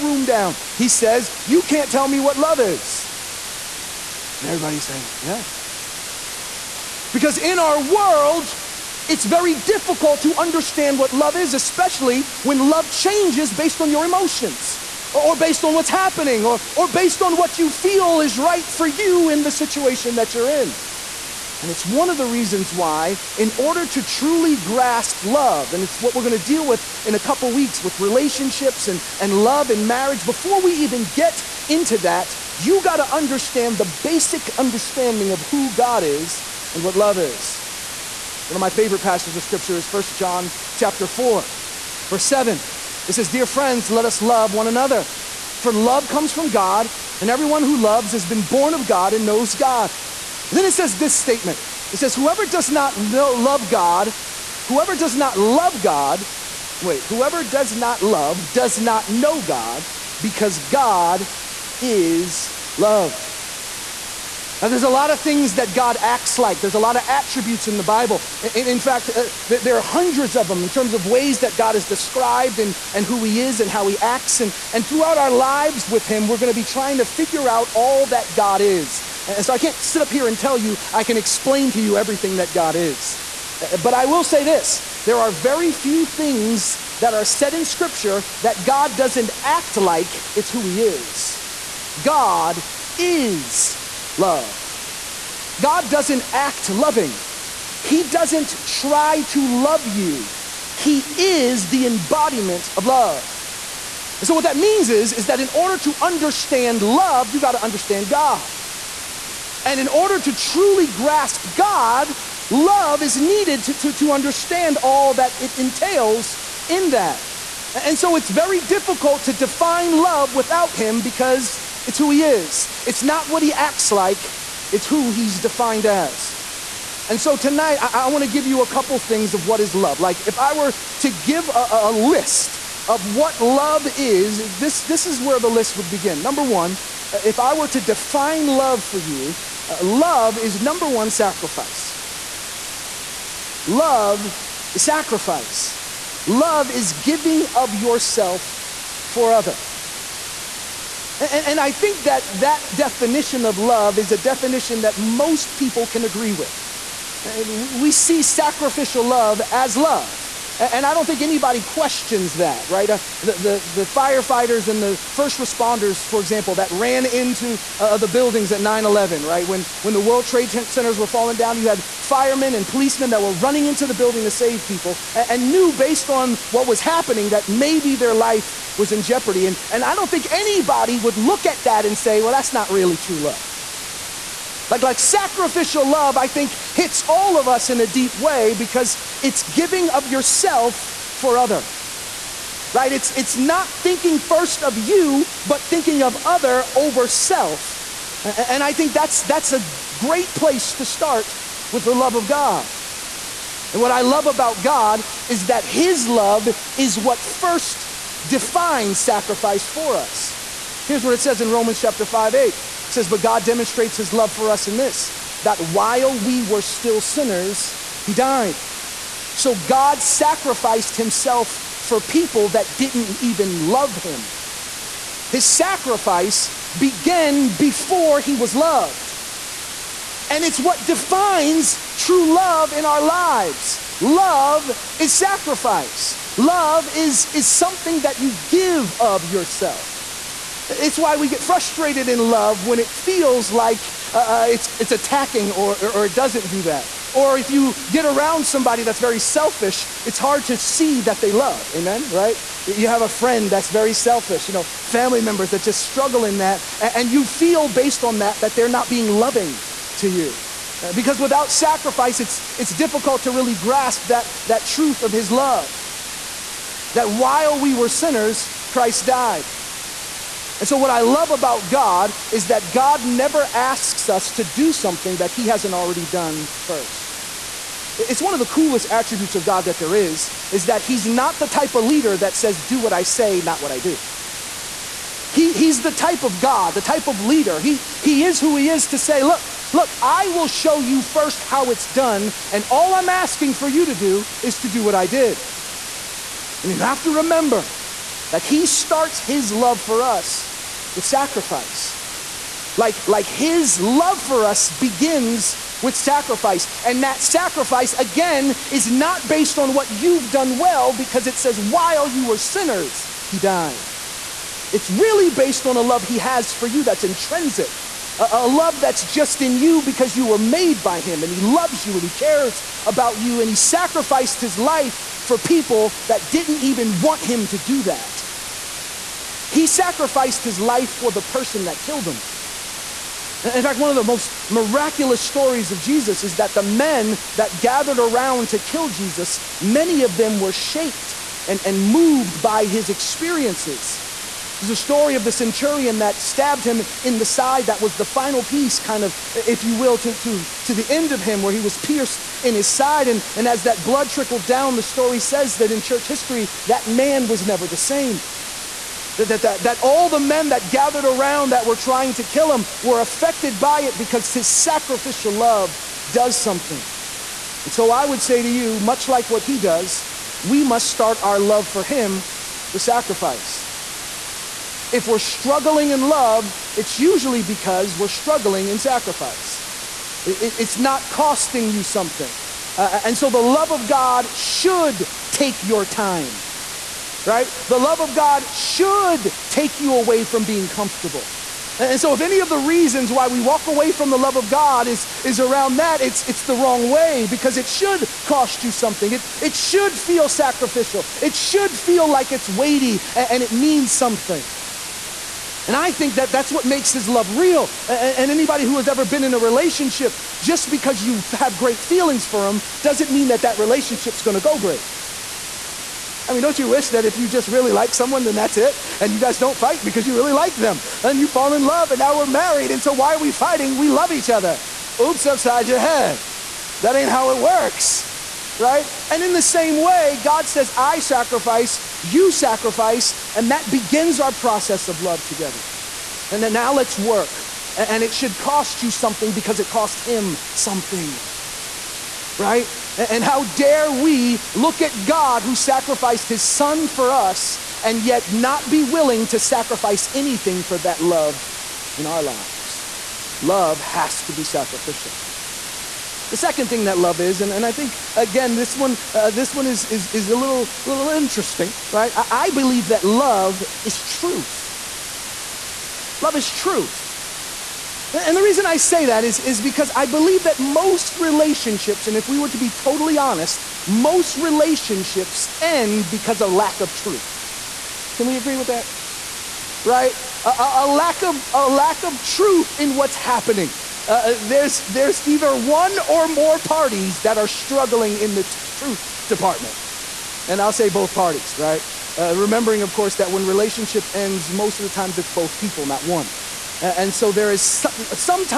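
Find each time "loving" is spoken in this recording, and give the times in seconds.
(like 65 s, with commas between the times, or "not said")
96 s, 259 s.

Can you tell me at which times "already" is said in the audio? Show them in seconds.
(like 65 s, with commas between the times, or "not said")
275 s.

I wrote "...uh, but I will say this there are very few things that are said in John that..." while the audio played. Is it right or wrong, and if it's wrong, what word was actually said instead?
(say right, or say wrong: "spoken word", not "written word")
wrong: "Scripture", not "John".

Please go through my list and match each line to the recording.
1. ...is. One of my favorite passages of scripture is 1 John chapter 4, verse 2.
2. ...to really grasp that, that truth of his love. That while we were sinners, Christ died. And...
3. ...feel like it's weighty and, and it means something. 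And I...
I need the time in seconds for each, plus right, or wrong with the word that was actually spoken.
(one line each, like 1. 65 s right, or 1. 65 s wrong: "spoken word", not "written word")
1. 37 s wrong: "7", not "2"
2. 263 s right
3. 401 s right.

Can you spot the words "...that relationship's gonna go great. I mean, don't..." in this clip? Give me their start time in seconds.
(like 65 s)
413 s.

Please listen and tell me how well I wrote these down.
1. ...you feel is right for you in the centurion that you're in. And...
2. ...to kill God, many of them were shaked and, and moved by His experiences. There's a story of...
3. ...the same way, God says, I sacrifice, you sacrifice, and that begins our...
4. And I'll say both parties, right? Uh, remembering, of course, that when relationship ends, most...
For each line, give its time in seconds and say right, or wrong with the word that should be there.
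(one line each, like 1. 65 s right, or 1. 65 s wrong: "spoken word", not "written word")
1. 17 s wrong: "situation", not "centurion"
2. 338 s wrong: "Jesus", not "God"
3. 429 s right
4. 490 s right.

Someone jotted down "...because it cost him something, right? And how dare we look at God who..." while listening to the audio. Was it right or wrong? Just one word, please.
right.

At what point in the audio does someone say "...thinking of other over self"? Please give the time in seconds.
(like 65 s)
195 s.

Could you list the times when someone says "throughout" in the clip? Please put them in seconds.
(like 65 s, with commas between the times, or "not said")
74 s.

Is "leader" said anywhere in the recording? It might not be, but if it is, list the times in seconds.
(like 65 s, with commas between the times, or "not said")
281 s, 287 s.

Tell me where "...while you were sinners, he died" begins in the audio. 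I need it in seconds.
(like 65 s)
311 s.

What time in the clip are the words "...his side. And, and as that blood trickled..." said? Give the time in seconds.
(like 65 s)
352 s.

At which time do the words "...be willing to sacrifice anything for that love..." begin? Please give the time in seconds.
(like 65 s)
448 s.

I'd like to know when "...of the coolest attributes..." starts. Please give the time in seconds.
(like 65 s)
278 s.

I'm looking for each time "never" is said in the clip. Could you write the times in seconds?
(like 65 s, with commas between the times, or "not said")
273 s, 357 s.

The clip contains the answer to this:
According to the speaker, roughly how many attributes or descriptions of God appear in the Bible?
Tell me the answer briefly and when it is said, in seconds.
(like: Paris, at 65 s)
hundreds, at 69 s.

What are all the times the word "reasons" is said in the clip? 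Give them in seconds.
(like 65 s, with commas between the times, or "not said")
22 s, 392 s, 468 s.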